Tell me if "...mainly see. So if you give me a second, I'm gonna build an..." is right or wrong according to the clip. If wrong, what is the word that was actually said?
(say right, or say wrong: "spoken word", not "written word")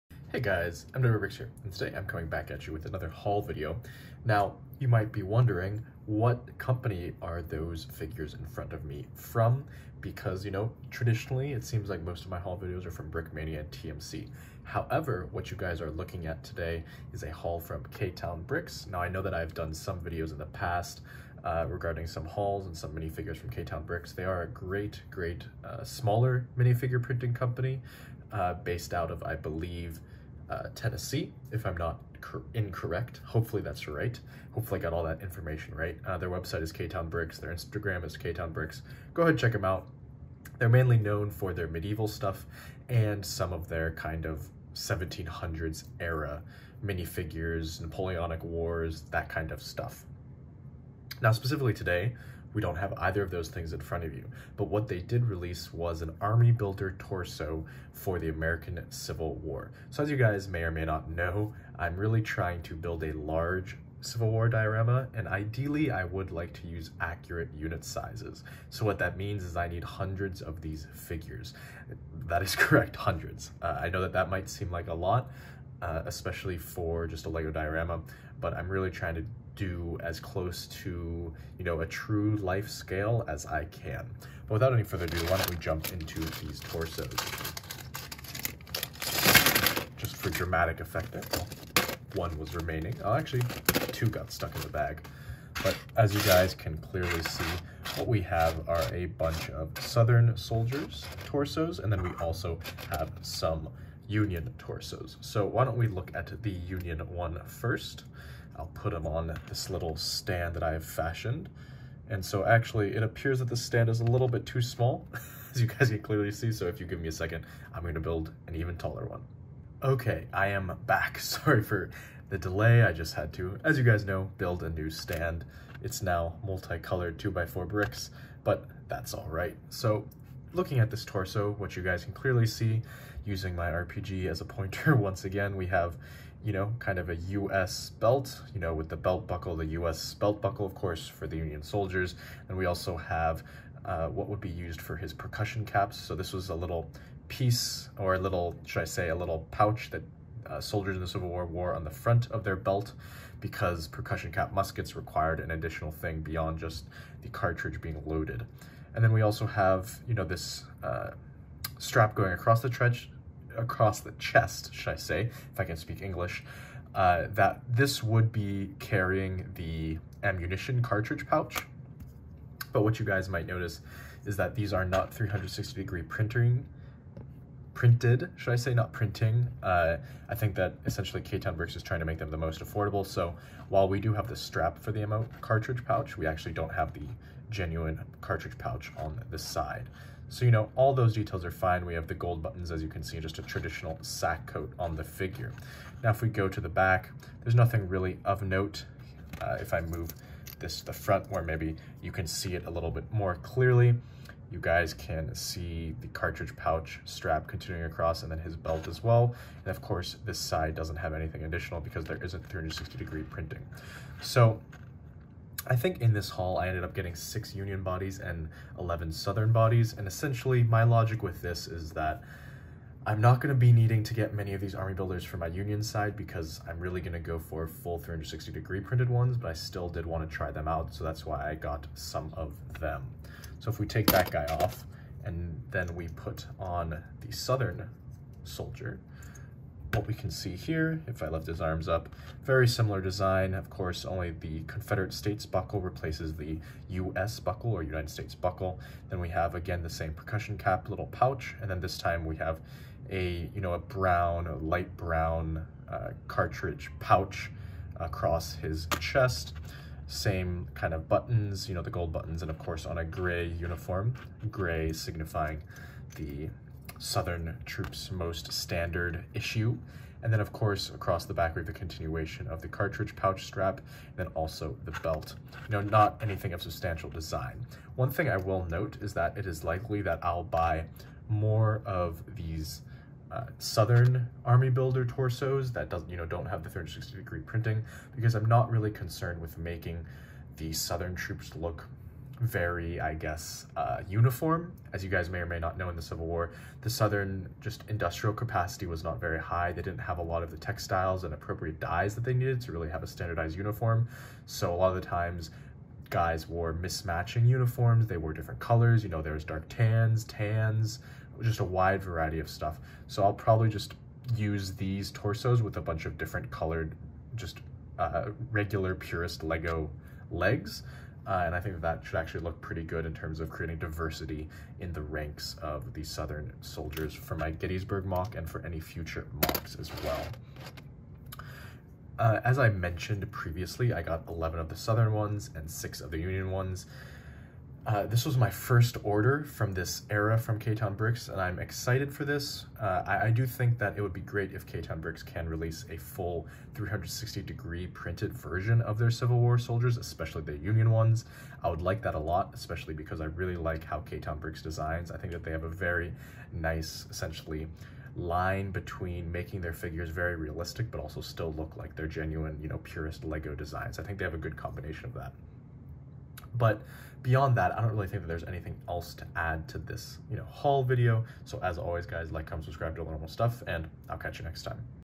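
wrong: "clearly", not "mainly".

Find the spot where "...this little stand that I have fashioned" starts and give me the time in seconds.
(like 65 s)
109 s.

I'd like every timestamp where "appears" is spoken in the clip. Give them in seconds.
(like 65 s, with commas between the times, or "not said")
113 s.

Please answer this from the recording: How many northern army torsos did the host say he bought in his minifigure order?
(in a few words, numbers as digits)
6.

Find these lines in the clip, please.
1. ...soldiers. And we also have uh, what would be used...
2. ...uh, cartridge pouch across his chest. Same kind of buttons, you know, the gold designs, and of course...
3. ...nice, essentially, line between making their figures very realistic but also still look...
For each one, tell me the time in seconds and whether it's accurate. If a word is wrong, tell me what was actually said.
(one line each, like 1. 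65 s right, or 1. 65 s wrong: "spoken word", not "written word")
1. 141 s right
2. 255 s wrong: "buttons", not "designs"
3. 356 s right.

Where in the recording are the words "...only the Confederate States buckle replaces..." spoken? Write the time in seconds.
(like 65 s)
244 s.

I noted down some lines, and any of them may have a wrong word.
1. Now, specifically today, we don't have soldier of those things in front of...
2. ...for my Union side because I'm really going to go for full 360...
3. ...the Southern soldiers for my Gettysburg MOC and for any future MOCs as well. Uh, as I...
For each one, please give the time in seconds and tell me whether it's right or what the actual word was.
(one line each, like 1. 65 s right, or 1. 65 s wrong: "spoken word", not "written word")
1. 51 s wrong: "either", not "soldier"
2. 225 s right
3. 325 s right.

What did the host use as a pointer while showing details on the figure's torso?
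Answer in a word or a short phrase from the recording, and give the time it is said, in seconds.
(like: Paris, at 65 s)
RPG, at 133 s.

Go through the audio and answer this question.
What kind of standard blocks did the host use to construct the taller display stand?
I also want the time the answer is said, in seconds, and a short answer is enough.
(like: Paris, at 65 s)
2x4 bricks, at 127 s.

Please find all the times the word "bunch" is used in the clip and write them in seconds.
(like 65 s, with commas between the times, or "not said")
99 s, 315 s.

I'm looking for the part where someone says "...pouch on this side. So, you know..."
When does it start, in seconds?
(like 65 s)
188 s.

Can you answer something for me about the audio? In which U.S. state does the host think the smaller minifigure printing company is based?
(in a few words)
Tennessee.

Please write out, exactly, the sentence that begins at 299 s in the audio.
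They didn't have a lot of the textiles and appropriate dyes that they needed to really have a standardized uniform.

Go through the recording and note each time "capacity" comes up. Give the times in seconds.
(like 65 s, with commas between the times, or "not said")
298 s.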